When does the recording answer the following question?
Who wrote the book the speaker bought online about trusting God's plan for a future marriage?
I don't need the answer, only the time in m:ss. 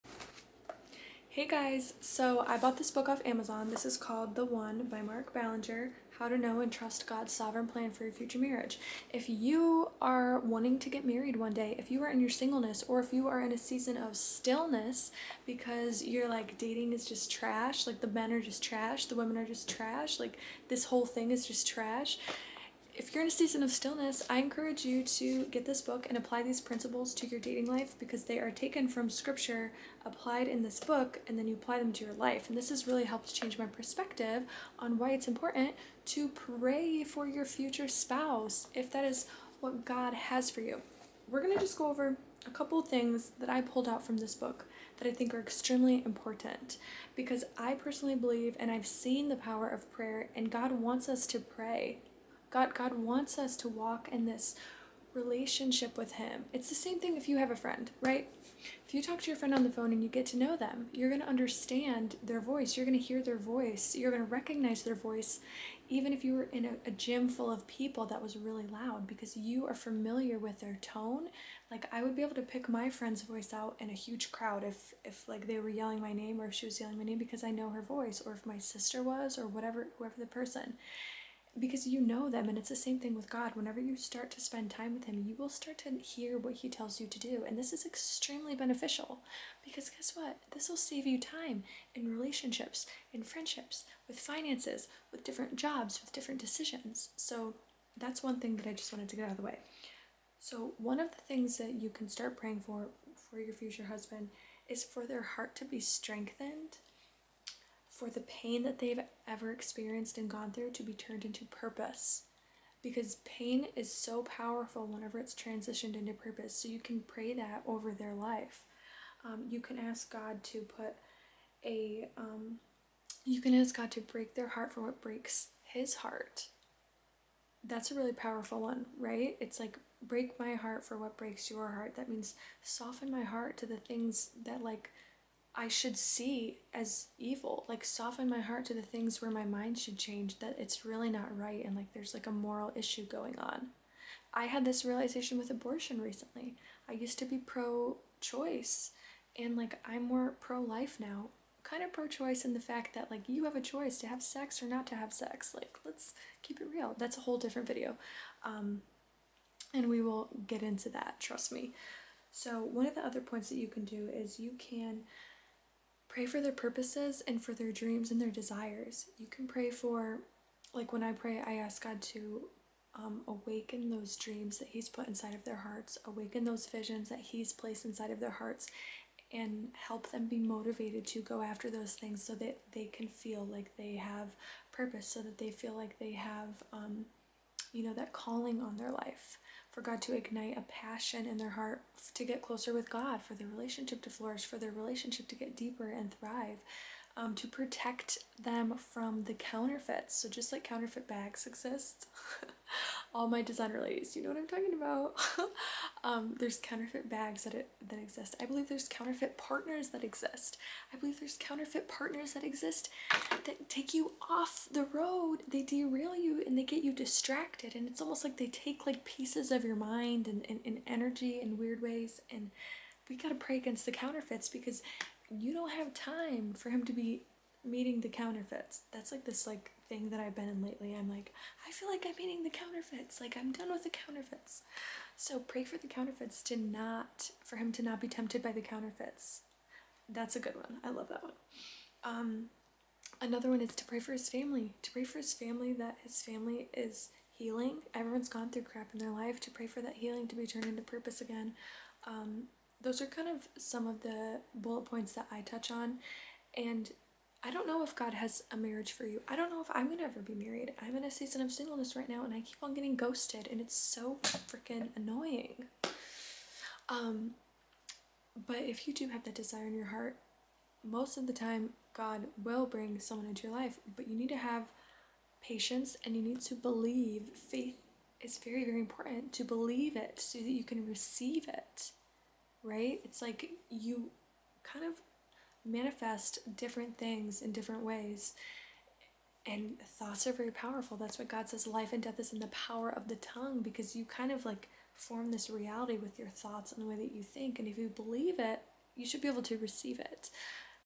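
0:05.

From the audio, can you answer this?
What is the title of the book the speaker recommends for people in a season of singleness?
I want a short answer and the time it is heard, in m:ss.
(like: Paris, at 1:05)
The One, at 0:04.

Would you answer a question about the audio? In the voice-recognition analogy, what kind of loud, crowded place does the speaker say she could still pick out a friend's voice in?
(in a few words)
gym.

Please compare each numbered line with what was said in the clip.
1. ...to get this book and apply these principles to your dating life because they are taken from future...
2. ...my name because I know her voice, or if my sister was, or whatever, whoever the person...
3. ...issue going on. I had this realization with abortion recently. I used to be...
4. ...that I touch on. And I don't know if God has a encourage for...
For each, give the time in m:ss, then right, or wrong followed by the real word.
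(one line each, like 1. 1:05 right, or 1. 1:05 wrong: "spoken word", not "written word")
1. 0:25 wrong: "scripture", not "future"
2. 1:16 right
3. 2:22 right
4. 4:15 wrong: "marriage", not "encourage".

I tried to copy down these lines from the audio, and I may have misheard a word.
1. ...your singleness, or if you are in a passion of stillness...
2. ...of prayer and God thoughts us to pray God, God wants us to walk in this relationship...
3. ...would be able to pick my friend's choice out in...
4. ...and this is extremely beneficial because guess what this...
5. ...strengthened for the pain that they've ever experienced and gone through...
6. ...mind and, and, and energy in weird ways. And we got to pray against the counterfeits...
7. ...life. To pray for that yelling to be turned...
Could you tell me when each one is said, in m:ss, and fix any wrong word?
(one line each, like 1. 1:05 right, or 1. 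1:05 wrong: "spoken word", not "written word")
1. 0:12 wrong: "season", not "passion"
2. 0:49 wrong: "wants", not "thoughts"
3. 1:12 wrong: "voice", not "choice"
4. 1:27 right
5. 1:45 right
6. 3:39 right
7. 4:09 wrong: "healing", not "yelling".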